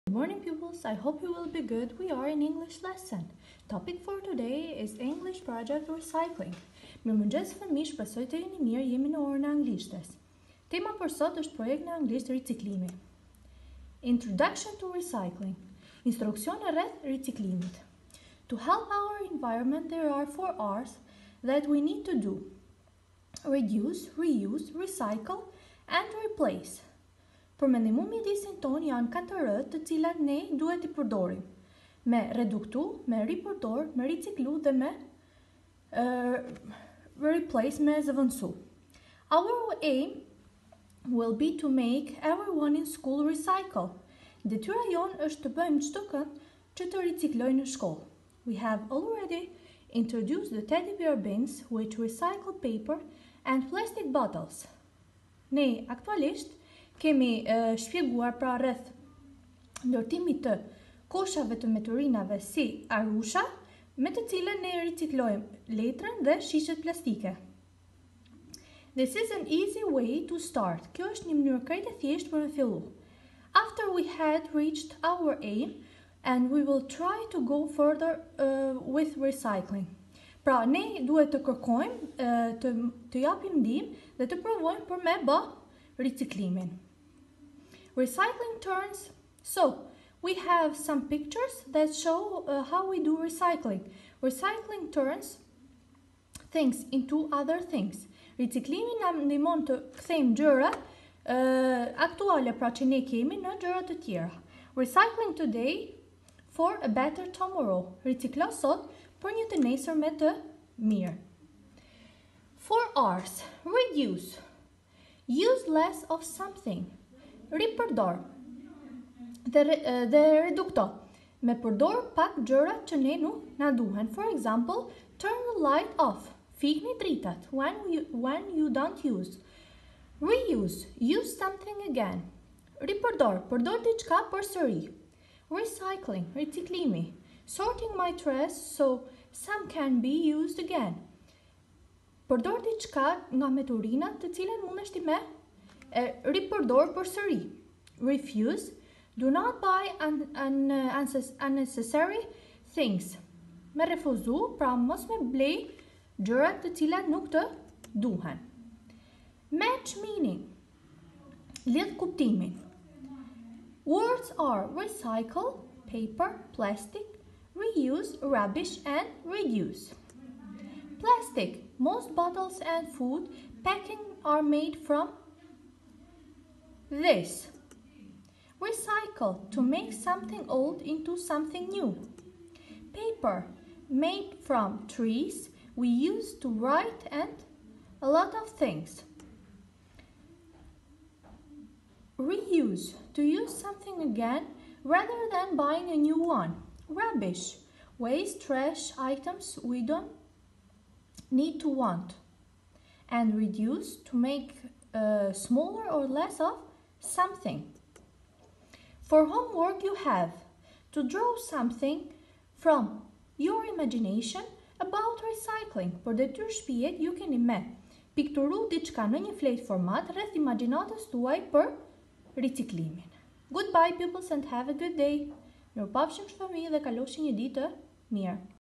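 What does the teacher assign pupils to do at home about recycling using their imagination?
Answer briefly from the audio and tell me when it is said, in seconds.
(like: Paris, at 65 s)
Draw something, at 211 s.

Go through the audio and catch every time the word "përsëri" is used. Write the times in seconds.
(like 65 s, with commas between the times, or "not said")
133 s.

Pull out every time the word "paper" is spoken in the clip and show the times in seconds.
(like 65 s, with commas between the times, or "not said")
52 s, 165 s, 182 s.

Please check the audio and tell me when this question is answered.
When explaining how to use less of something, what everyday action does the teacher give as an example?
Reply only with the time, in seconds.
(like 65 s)
125 s.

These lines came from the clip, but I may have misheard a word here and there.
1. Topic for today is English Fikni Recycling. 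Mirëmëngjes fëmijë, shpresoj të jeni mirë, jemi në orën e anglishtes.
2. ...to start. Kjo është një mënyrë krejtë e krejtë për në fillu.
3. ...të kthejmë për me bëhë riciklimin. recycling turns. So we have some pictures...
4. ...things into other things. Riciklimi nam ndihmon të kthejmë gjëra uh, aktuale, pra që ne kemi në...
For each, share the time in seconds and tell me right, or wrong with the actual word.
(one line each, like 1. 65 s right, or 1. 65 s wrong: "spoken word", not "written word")
1. 3 s wrong: "Project", not "Fikni"
2. 70 s wrong: "thjeshtë", not "krejtë"
3. 84 s wrong: "provojmë", not "kthejmë"
4. 96 s right.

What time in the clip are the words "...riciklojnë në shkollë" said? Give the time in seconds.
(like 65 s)
47 s.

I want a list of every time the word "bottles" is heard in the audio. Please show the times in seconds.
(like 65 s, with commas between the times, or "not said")
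54 s, 172 s.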